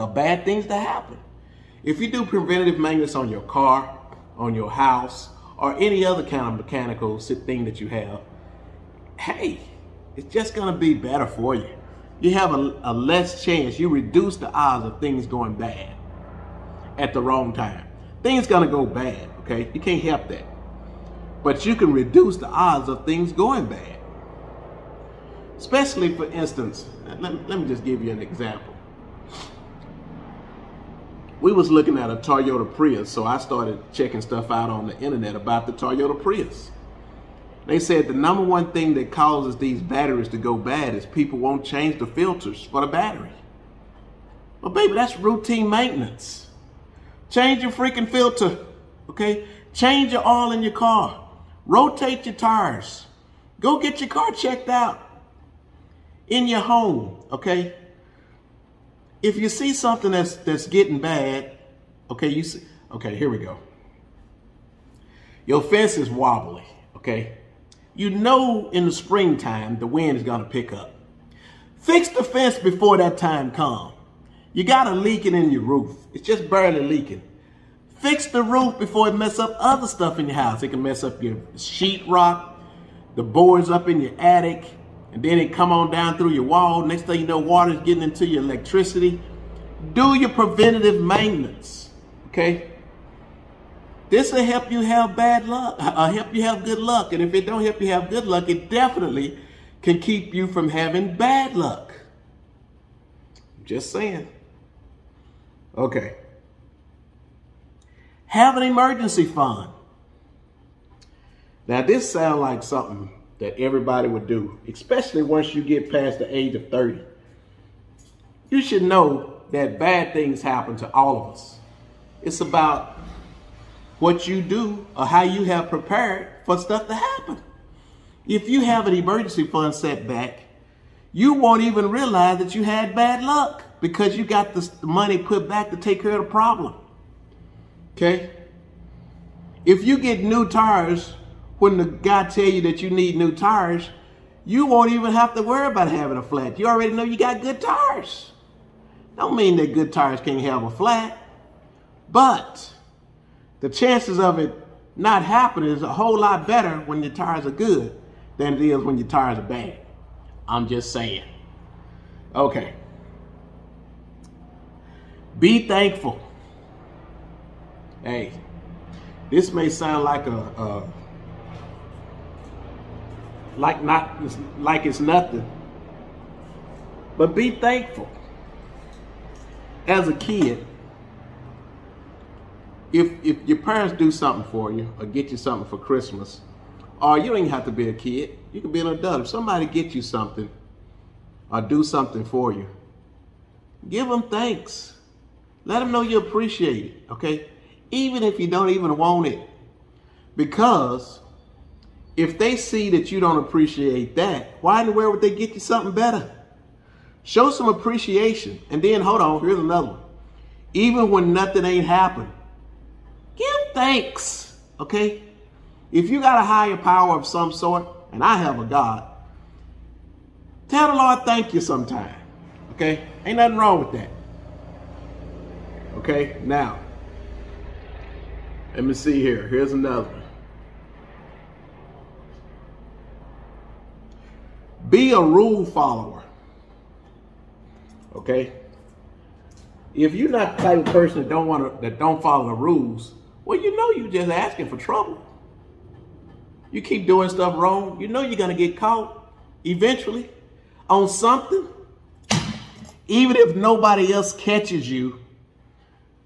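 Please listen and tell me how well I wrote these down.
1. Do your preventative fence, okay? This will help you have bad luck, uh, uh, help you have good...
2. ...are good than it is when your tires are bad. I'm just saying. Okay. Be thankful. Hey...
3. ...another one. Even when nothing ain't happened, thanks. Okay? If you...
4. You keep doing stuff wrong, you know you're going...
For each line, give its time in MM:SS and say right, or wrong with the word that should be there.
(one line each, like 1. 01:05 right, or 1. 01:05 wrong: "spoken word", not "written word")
1. 01:29 wrong: "maintenance", not "fence"
2. 02:37 right
3. 03:29 right
4. 04:06 right.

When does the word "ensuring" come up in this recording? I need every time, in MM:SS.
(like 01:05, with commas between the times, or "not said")
not said.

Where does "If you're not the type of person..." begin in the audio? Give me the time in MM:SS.
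03:59.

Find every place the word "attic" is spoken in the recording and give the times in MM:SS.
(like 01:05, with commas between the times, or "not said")
01:24.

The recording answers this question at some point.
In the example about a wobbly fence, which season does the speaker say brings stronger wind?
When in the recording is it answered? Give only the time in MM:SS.
01:08.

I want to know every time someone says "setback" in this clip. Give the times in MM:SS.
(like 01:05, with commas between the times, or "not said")
02:09.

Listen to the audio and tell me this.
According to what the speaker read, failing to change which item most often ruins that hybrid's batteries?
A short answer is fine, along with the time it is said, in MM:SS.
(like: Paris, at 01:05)
filters, at 00:41.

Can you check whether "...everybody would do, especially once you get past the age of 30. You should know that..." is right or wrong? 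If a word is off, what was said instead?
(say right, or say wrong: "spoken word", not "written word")
right.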